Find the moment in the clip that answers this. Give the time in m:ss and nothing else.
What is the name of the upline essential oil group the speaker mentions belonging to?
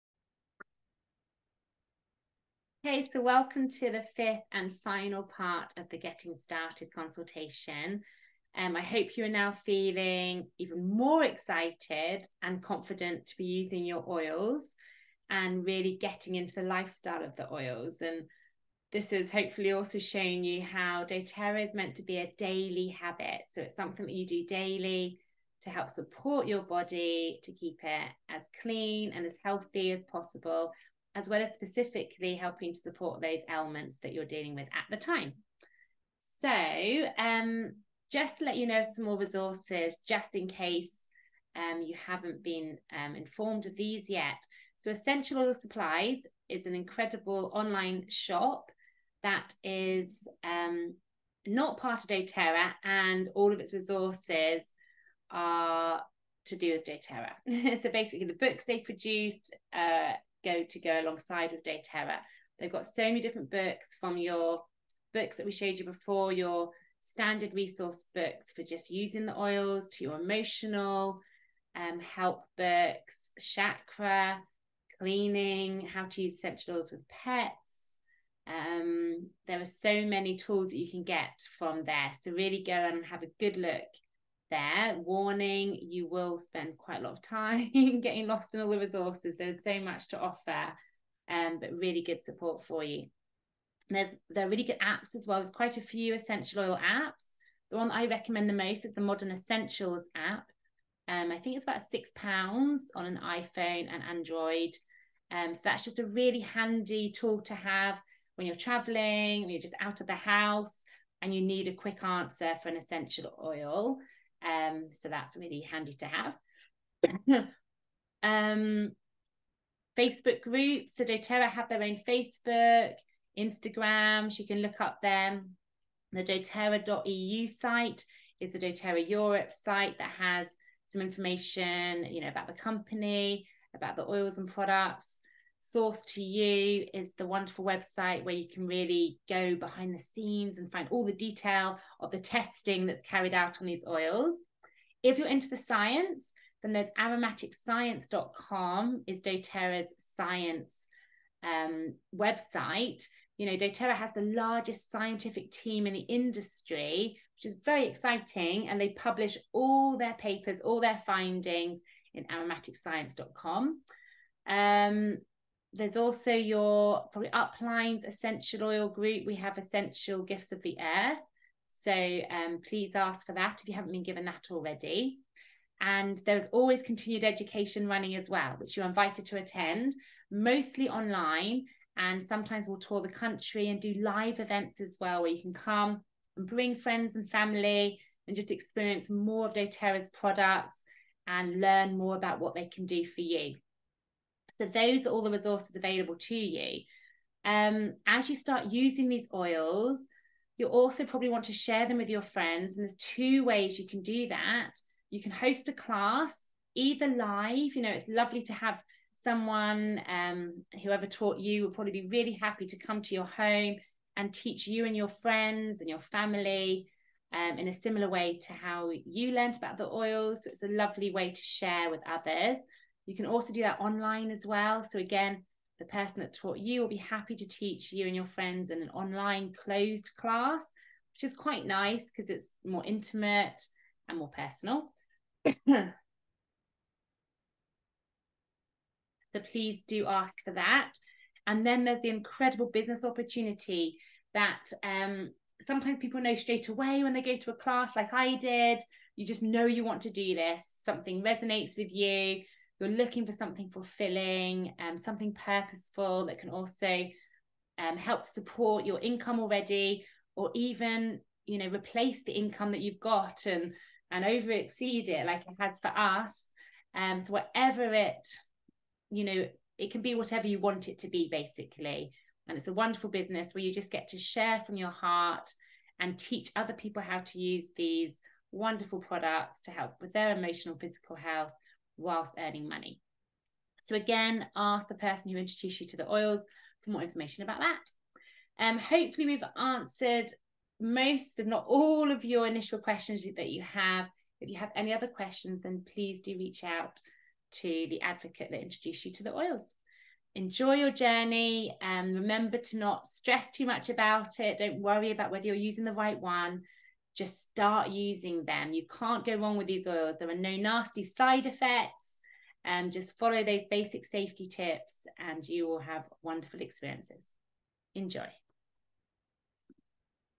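2:49.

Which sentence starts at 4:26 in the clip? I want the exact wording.
Um, so whatever it, you know, it can be whatever you want it to be basically.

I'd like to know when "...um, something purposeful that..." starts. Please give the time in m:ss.
4:14.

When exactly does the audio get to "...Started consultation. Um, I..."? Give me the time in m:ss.
0:06.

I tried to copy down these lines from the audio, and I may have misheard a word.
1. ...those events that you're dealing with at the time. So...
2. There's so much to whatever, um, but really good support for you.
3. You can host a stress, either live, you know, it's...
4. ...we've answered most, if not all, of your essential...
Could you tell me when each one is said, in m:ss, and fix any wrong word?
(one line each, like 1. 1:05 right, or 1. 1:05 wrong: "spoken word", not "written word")
1. 0:33 wrong: "ailments", not "events"
2. 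1:29 wrong: "offer", not "whatever"
3. 3:25 wrong: "class", not "stress"
4. 4:49 wrong: "initial", not "essential".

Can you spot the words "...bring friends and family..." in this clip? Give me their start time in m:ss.
3:06.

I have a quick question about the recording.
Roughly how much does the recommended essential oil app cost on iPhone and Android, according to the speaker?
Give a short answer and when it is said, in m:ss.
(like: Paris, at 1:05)
6 pounds, at 1:41.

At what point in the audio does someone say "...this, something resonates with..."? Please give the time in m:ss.
4:10.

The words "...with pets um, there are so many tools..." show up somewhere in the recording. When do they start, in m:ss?
1:16.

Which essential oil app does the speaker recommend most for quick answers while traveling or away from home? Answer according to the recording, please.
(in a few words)
Modern Essentials.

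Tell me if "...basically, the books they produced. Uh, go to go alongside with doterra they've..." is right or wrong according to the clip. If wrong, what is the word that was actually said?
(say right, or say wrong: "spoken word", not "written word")
right.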